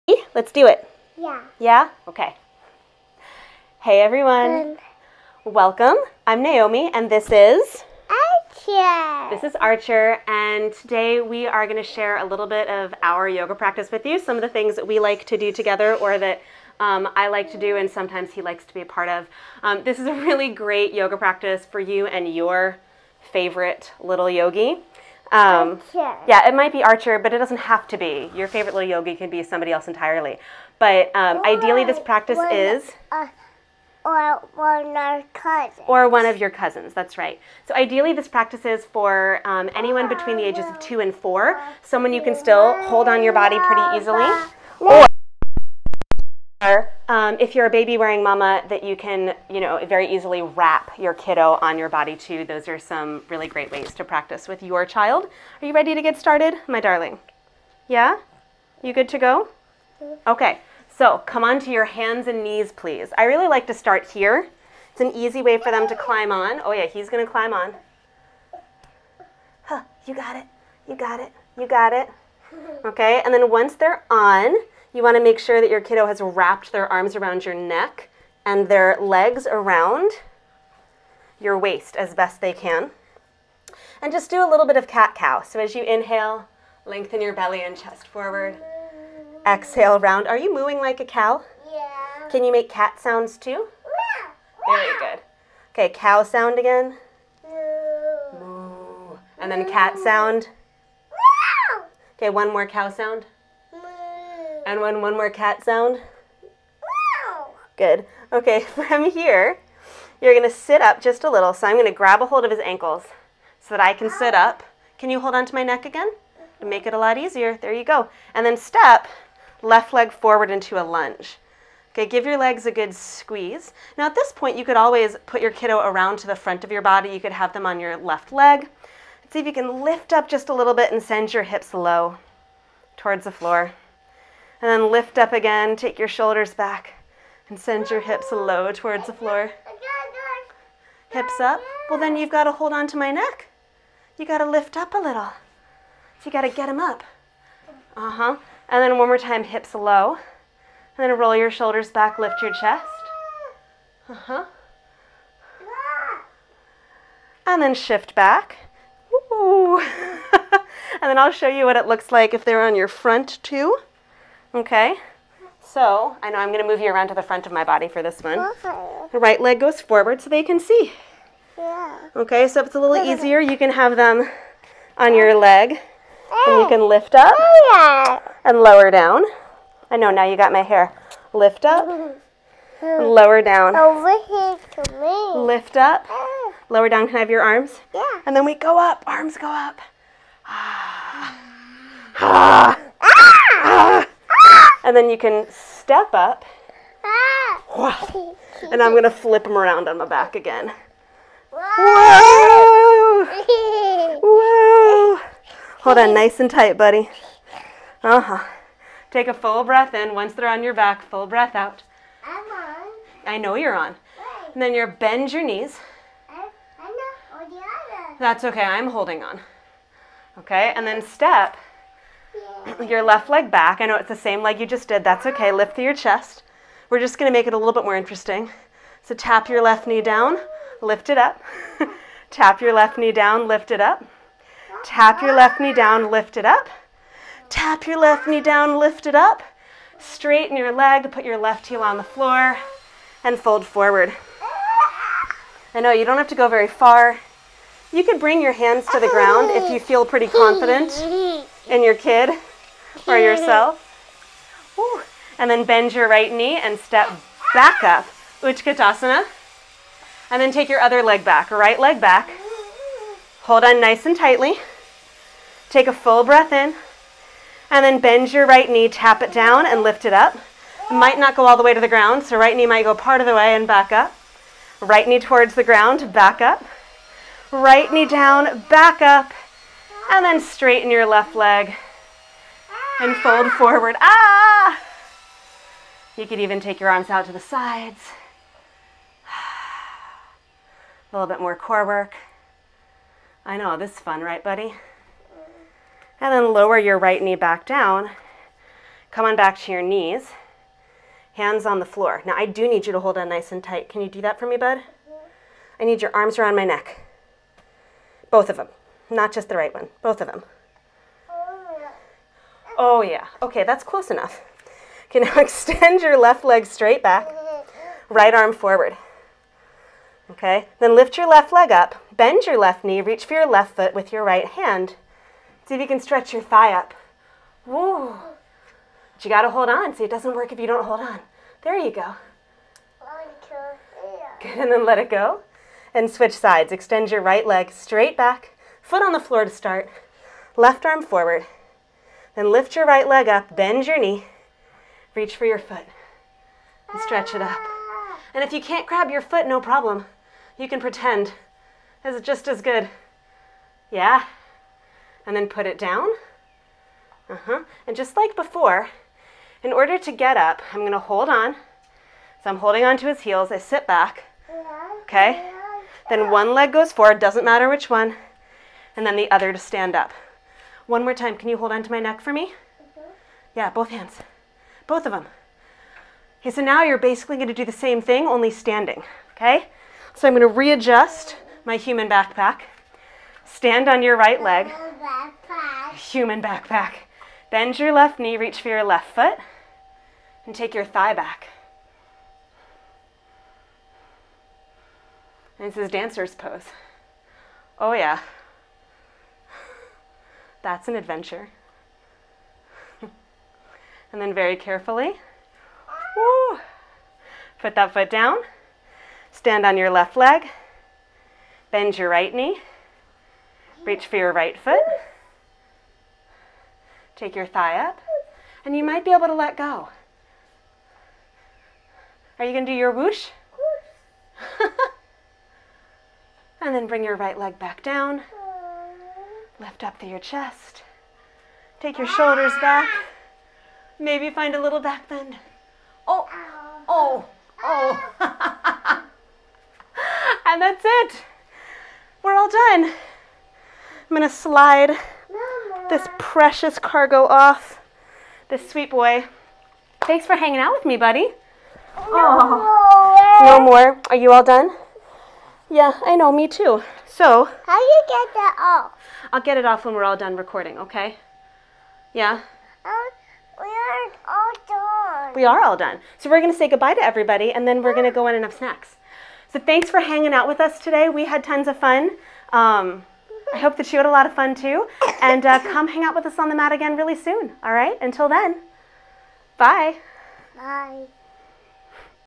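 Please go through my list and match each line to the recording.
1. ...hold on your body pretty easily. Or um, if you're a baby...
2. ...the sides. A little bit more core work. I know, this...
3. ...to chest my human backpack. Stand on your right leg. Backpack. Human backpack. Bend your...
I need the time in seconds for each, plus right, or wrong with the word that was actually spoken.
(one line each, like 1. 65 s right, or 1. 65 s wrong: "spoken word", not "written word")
1. 42 s right
2. 287 s right
3. 380 s wrong: "readjust", not "chest".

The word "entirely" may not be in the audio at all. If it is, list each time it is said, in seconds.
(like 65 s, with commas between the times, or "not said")
29 s.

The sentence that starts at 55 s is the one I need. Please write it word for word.
Are you ready to get started, my darling?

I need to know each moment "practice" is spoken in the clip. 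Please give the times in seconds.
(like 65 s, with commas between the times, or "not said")
13 s, 21 s, 31 s, 38 s, 54 s.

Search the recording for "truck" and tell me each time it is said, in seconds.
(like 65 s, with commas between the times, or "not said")
not said.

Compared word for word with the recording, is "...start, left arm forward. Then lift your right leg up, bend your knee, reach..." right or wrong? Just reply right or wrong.
right.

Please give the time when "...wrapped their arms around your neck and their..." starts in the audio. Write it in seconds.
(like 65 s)
76 s.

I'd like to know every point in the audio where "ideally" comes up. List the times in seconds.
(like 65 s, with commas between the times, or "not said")
31 s, 37 s.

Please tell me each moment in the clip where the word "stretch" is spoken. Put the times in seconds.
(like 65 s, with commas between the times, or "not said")
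325 s, 347 s.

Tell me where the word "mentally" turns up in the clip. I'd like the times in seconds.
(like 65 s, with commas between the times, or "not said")
not said.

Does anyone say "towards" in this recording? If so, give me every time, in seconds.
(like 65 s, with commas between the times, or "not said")
132 s, 138 s, 275 s.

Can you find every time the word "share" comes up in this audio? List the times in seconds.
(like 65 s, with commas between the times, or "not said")
11 s.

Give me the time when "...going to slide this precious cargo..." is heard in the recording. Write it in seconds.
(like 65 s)
444 s.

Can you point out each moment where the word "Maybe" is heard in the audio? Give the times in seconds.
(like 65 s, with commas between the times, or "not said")
433 s.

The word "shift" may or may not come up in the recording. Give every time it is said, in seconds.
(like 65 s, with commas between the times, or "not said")
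157 s.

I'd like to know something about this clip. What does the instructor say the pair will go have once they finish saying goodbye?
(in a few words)
Snacks.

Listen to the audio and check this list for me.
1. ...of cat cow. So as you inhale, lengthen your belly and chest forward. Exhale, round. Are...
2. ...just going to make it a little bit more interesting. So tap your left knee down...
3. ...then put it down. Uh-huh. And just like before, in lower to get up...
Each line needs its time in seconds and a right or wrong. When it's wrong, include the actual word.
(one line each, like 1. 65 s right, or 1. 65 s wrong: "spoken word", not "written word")
1. 84 s right
2. 226 s right
3. 355 s wrong: "order", not "lower".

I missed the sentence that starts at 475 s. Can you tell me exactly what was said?
And uh, come hang out with us on the mat again really soon.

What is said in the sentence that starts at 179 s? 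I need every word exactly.
I know, now you got my hair.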